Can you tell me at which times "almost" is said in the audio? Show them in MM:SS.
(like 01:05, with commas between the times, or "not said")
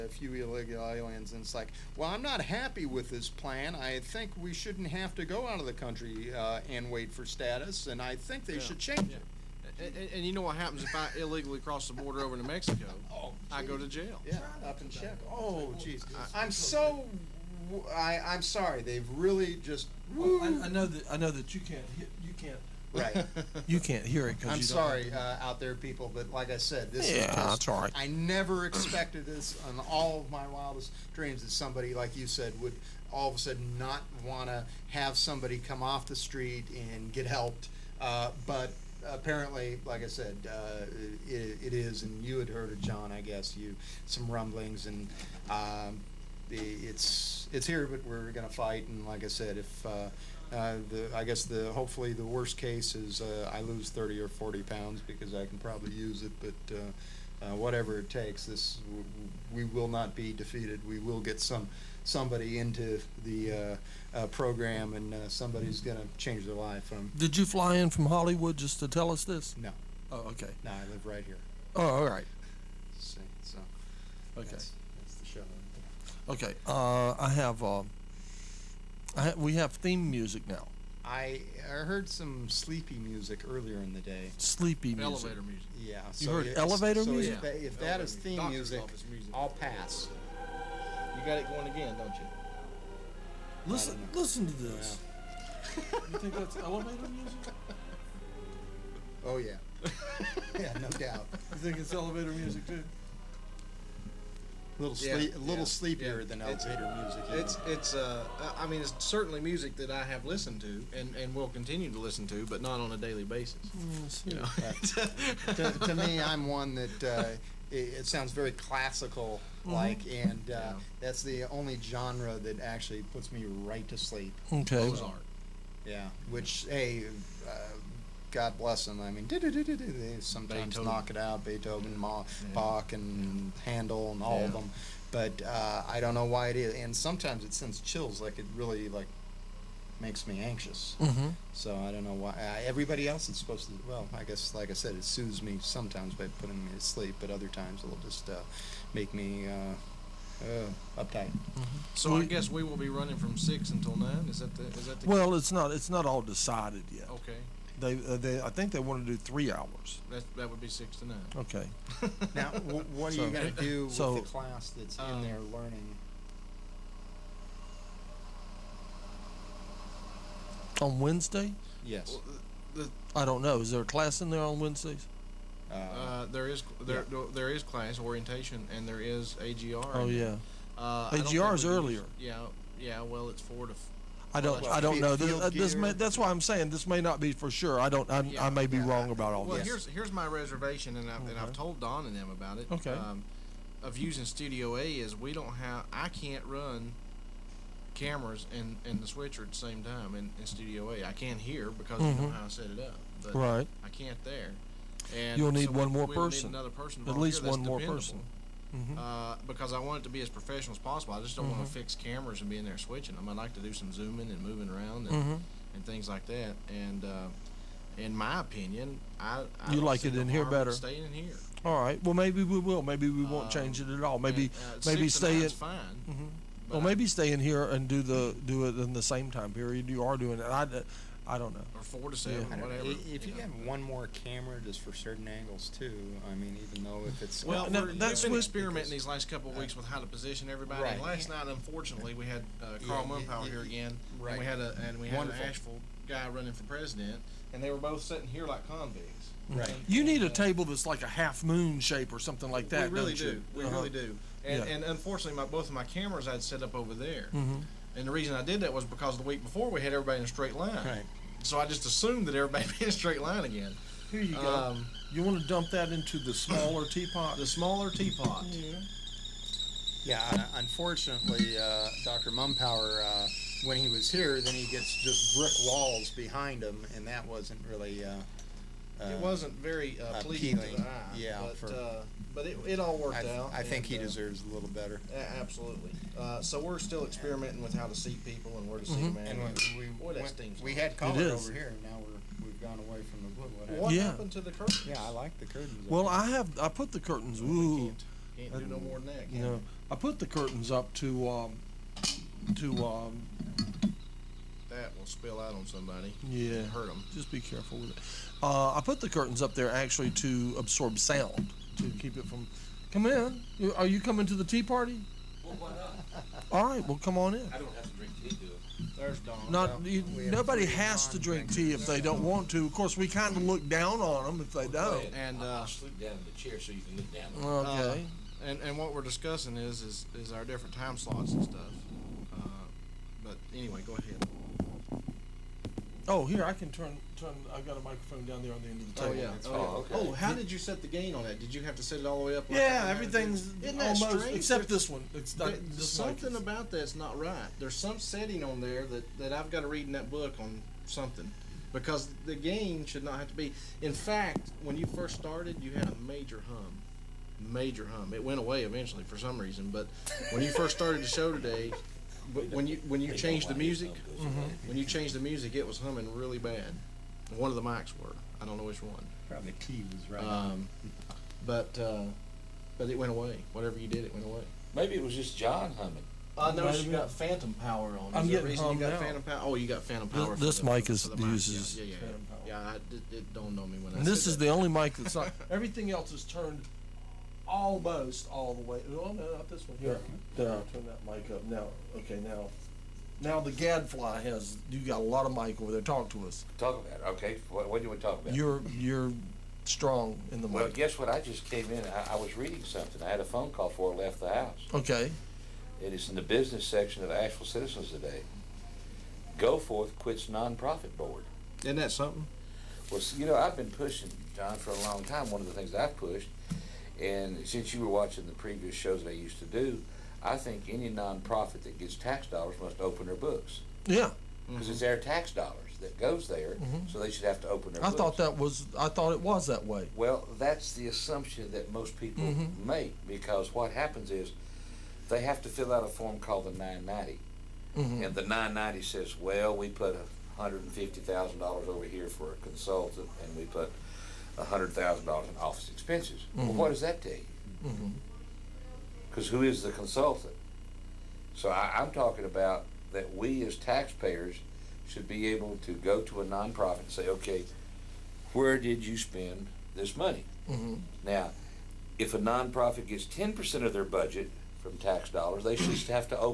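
05:43, 06:27.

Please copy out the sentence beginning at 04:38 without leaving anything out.
Uh, it uh, wasn't very uh, pleasing to the eye.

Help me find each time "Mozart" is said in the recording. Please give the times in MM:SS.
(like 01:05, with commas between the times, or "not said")
02:04.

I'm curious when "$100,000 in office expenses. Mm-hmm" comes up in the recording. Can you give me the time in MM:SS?
07:24.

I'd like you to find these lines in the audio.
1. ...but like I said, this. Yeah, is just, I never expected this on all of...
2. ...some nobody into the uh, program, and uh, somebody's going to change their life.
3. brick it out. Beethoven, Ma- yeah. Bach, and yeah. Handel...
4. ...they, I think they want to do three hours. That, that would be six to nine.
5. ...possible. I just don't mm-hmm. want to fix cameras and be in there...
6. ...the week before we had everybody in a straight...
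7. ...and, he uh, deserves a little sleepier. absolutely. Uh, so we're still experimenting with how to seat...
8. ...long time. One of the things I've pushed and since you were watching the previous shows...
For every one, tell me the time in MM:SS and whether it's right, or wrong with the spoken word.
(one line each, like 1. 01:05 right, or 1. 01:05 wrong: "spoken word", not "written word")
1. 00:26 right
2. 01:01 wrong: "somebody", not "nobody"
3. 02:10 wrong: "knock", not "brick"
4. 02:38 right
5. 03:30 right
6. 04:19 right
7. 04:43 wrong: "better", not "sleepier"
8. 06:54 right.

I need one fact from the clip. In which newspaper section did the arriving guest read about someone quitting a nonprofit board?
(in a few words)
business section.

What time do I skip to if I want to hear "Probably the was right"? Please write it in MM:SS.
06:09.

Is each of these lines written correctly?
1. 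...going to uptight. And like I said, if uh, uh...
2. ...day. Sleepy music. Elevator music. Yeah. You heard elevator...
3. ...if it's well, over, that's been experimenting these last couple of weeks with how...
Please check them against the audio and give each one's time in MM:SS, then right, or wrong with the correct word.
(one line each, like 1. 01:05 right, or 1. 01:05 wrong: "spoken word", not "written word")
1. 00:48 wrong: "fight", not "uptight"
2. 01:23 right
3. 03:57 right.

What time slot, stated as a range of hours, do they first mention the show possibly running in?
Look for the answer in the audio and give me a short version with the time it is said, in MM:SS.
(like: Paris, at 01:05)
6 to 9, at 02:33.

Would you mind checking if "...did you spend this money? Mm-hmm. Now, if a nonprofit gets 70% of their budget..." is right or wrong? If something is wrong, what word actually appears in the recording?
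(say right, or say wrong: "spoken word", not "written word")
wrong: "10", not "70".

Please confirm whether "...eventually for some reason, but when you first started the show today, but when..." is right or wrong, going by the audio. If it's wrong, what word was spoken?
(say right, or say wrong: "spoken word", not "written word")
right.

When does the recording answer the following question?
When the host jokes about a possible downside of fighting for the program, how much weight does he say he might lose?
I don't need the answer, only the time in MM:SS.
00:53.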